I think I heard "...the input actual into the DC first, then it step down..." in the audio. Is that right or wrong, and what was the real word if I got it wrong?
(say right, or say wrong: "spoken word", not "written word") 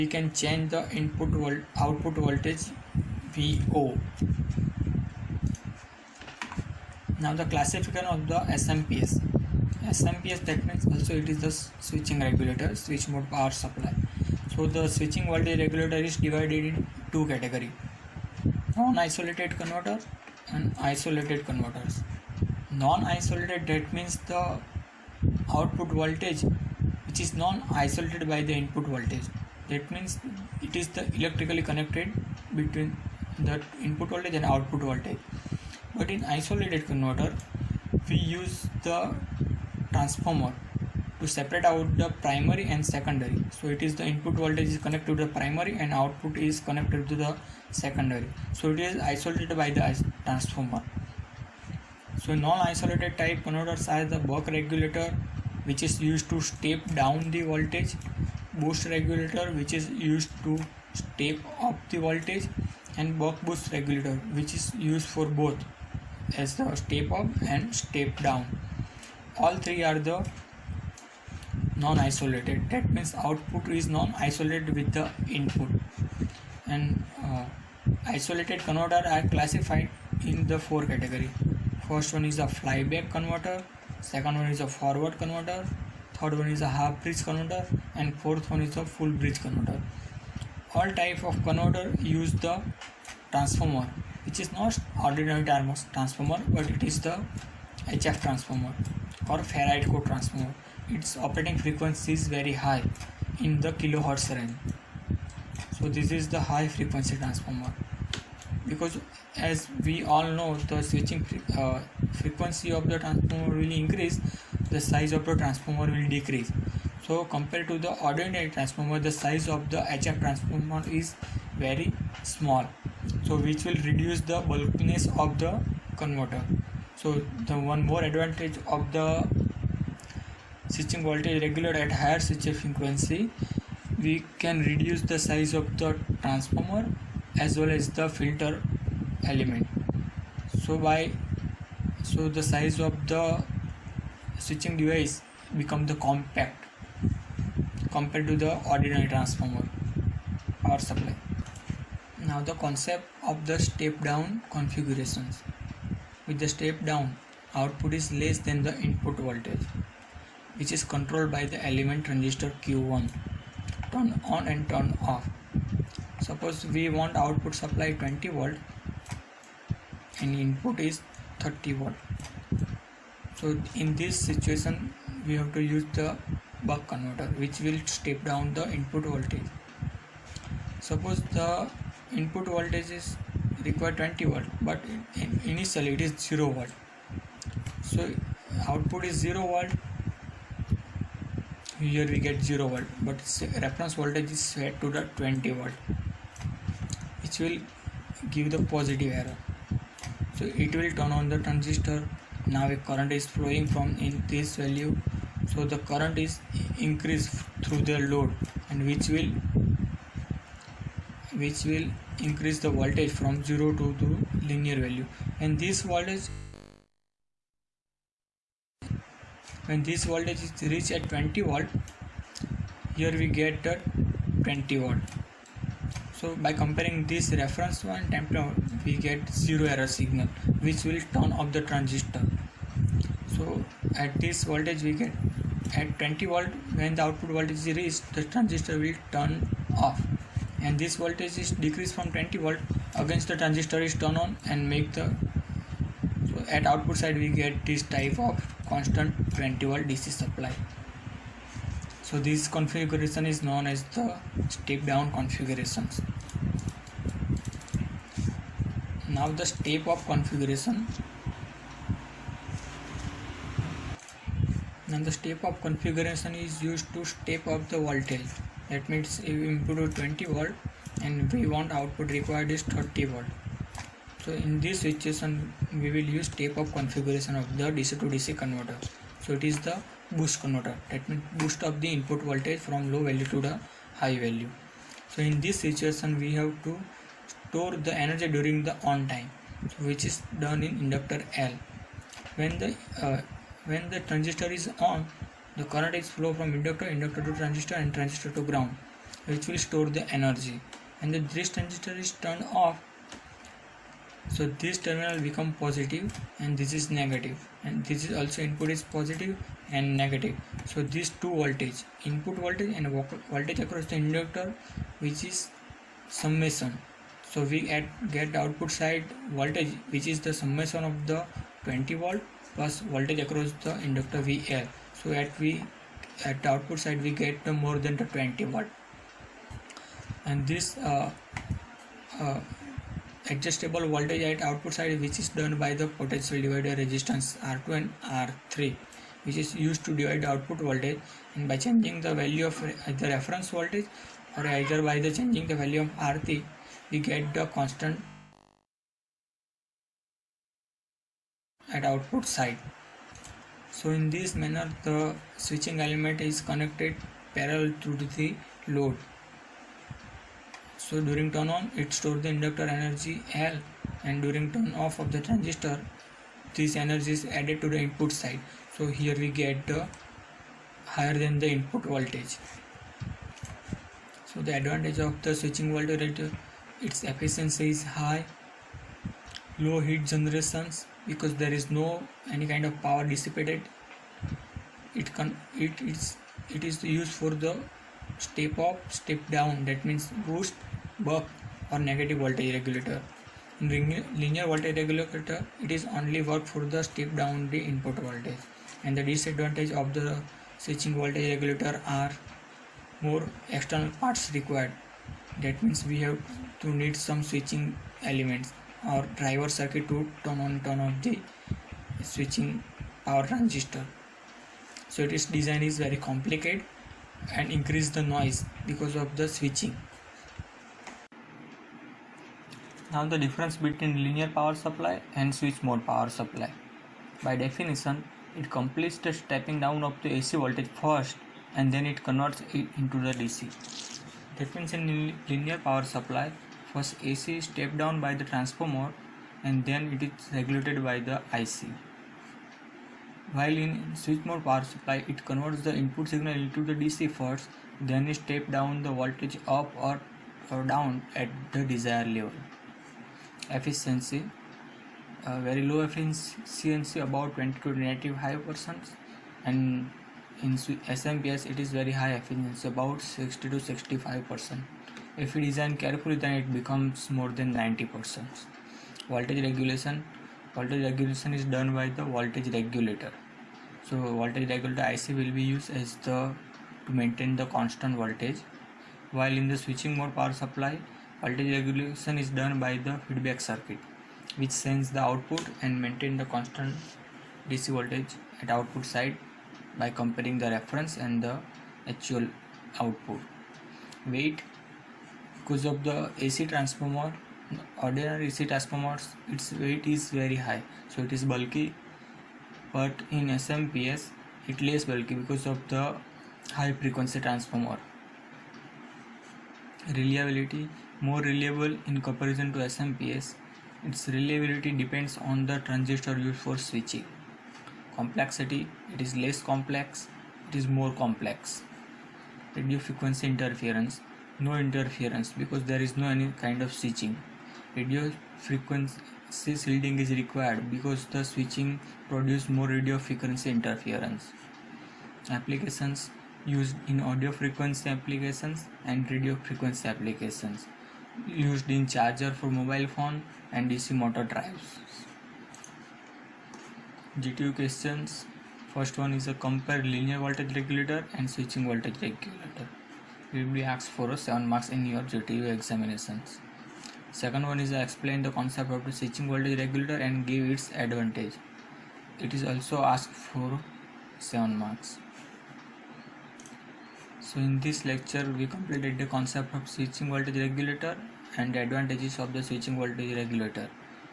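wrong: "signal", not "actual".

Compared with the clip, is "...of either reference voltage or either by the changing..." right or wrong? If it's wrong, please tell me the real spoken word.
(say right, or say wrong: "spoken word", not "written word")
right.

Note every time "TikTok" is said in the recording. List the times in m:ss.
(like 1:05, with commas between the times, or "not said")
not said.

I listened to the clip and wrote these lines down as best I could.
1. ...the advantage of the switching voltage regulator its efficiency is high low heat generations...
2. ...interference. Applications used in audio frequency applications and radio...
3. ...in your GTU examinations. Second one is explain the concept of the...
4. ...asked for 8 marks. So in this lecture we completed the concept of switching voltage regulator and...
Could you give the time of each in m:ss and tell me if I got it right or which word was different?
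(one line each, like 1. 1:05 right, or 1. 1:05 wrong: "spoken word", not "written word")
1. 6:14 right
2. 8:53 right
3. 9:14 right
4. 9:22 wrong: "7", not "8".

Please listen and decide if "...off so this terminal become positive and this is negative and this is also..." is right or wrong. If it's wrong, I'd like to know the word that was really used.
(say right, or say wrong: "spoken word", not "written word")
right.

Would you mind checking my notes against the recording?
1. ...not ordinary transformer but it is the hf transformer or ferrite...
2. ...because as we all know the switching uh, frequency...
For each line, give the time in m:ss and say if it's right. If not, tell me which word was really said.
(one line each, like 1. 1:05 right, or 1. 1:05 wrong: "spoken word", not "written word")
1. 1:34 right
2. 1:48 right.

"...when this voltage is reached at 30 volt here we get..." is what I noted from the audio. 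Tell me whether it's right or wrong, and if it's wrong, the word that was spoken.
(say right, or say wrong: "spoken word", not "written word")
wrong: "20", not "30".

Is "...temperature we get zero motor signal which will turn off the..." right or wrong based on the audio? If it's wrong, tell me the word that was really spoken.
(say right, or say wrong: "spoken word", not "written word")
wrong: "error", not "motor".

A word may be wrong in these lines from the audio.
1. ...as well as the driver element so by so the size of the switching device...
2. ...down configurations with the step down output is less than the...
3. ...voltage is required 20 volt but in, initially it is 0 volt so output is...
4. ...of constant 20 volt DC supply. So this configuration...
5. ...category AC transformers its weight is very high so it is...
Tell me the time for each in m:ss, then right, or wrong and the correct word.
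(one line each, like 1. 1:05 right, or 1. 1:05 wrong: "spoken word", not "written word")
1. 2:17 wrong: "filter", not "driver"
2. 2:34 right
3. 3:02 right
4. 4:08 right
5. 8:17 wrong: "ordinary", not "category".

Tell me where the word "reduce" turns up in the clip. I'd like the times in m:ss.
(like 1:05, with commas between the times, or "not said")
2:03, 2:14.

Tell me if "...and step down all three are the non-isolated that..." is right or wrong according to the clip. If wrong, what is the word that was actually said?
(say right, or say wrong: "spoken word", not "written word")
right.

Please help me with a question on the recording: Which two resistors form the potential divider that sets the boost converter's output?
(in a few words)
R2 and R3.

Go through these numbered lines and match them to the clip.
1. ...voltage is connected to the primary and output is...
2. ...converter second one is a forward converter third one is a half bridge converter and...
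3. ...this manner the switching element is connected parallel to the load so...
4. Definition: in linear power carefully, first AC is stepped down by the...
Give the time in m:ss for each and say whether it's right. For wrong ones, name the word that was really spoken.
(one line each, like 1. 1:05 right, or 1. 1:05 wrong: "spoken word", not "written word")
1. 0:44 right
2. 1:23 right
3. 5:54 right
4. 7:14 wrong: "supply", not "carefully".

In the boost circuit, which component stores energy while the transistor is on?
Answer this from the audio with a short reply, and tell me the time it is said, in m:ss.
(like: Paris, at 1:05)
Inductor L, at 4:50.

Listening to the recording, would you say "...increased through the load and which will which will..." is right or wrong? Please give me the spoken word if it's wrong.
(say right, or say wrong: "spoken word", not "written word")
right.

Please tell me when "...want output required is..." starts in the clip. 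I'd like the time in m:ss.
4:31.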